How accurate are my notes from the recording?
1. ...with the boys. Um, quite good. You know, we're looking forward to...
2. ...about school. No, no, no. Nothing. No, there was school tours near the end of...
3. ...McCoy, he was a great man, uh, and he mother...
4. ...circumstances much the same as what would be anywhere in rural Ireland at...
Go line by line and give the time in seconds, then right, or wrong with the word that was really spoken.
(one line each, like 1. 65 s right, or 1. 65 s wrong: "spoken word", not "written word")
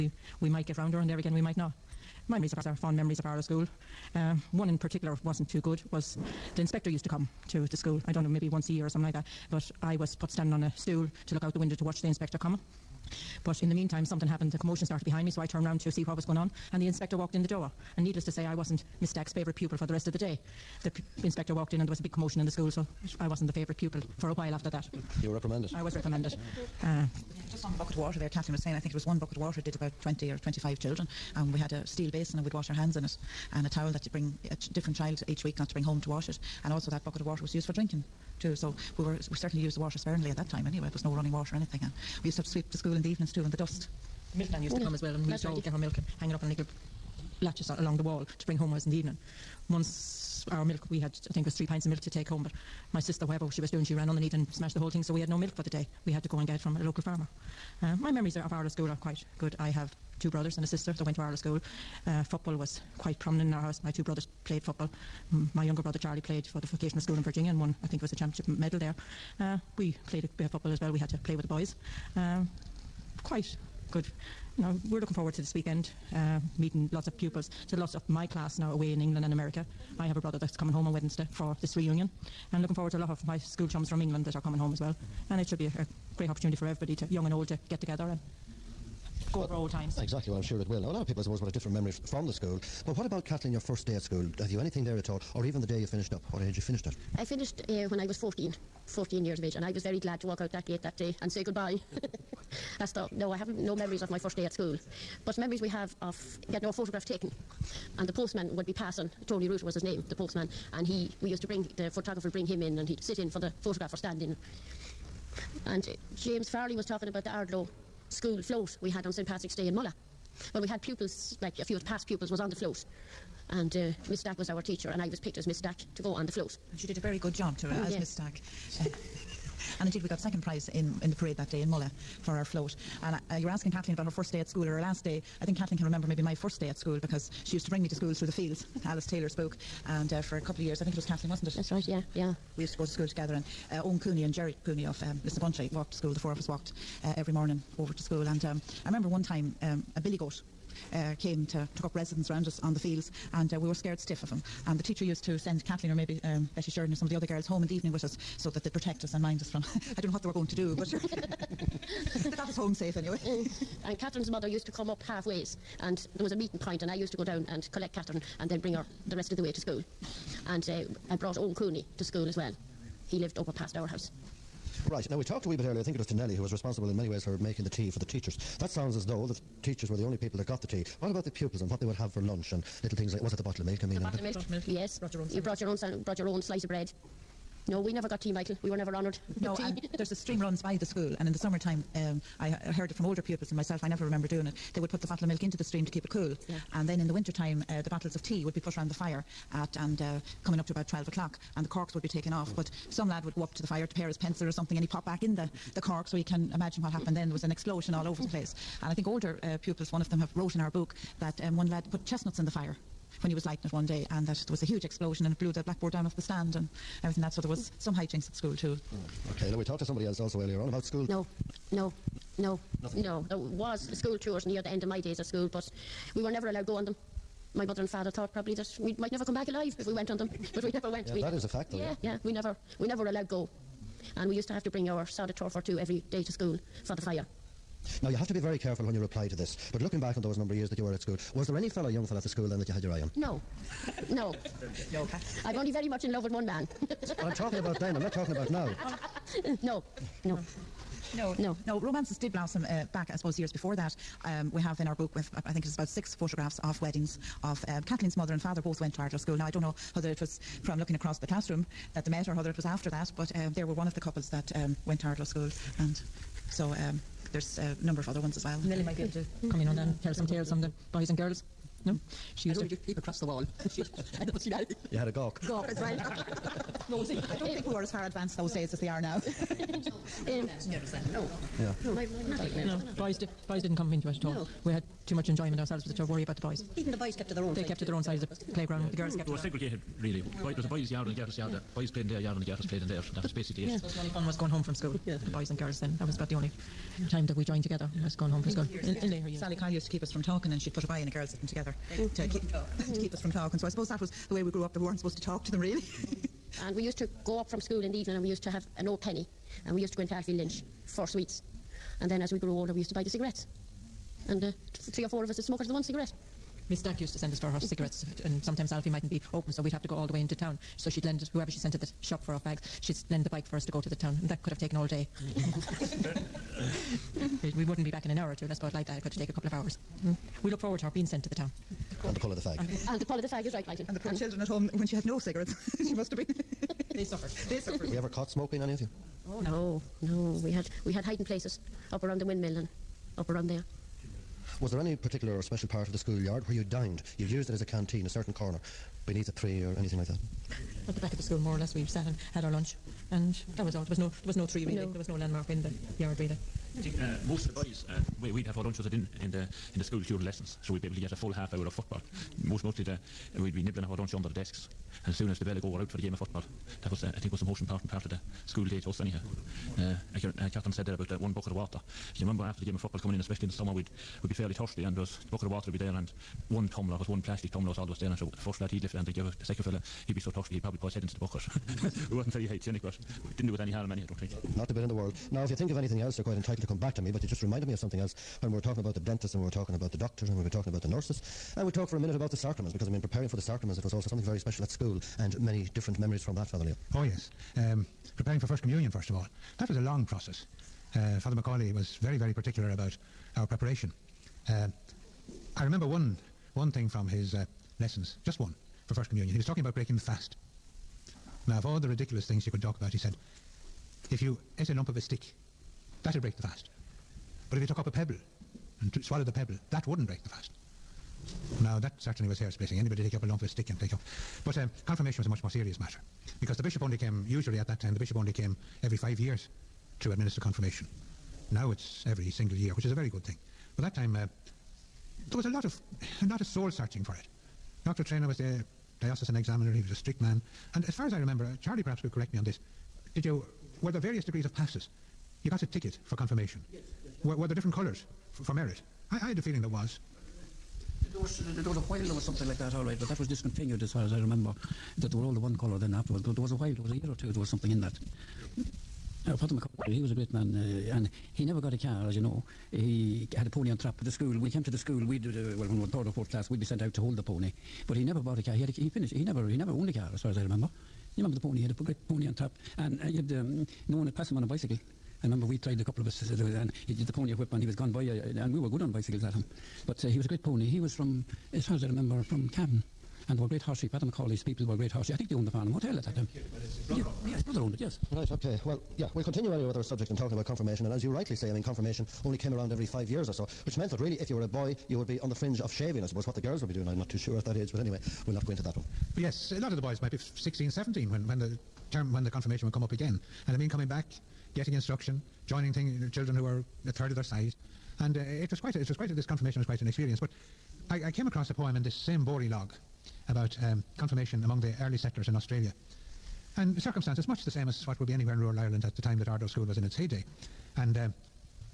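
1. 71 s right
2. 220 s right
3. 459 s wrong: "never", not "mother"
4. 516 s right.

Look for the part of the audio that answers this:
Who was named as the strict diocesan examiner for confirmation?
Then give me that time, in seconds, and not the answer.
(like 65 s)
437 s.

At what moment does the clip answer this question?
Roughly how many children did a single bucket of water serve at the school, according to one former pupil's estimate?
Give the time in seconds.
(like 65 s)
30 s.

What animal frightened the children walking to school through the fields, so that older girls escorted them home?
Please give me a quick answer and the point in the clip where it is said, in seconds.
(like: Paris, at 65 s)
A billy goat, at 149 s.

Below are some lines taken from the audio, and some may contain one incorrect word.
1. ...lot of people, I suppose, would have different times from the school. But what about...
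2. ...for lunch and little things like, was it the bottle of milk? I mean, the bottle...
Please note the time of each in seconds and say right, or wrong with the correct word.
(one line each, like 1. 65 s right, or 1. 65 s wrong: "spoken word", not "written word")
1. 90 s wrong: "memories", not "times"
2. 182 s right.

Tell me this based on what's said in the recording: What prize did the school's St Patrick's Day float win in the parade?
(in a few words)
Second prize.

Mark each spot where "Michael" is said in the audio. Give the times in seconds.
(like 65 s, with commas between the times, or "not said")
188 s, 333 s.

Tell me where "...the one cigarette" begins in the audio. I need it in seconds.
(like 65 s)
315 s.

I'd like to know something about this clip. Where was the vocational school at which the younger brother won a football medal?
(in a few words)
Virginia.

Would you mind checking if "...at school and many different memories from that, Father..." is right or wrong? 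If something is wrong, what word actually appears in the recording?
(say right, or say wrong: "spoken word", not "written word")
right.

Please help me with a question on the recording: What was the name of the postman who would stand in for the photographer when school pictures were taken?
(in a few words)
Tony Root.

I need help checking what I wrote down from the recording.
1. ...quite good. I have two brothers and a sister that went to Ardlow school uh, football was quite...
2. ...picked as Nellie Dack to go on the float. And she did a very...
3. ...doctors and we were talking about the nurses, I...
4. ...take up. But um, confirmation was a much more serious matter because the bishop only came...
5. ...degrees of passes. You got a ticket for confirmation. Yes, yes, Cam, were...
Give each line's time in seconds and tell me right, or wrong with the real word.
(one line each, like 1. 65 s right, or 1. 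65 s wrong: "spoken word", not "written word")
1. 59 s right
2. 125 s wrong: "Miss", not "Nellie"
3. 389 s right
4. 423 s right
5. 444 s wrong: "Were", not "Cam".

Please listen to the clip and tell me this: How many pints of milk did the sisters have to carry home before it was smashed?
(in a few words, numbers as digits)
3.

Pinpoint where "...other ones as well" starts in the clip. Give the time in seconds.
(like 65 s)
268 s.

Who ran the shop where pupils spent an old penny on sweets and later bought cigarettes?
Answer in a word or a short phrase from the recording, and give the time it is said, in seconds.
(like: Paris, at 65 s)
Alfie Lynch, at 310 s.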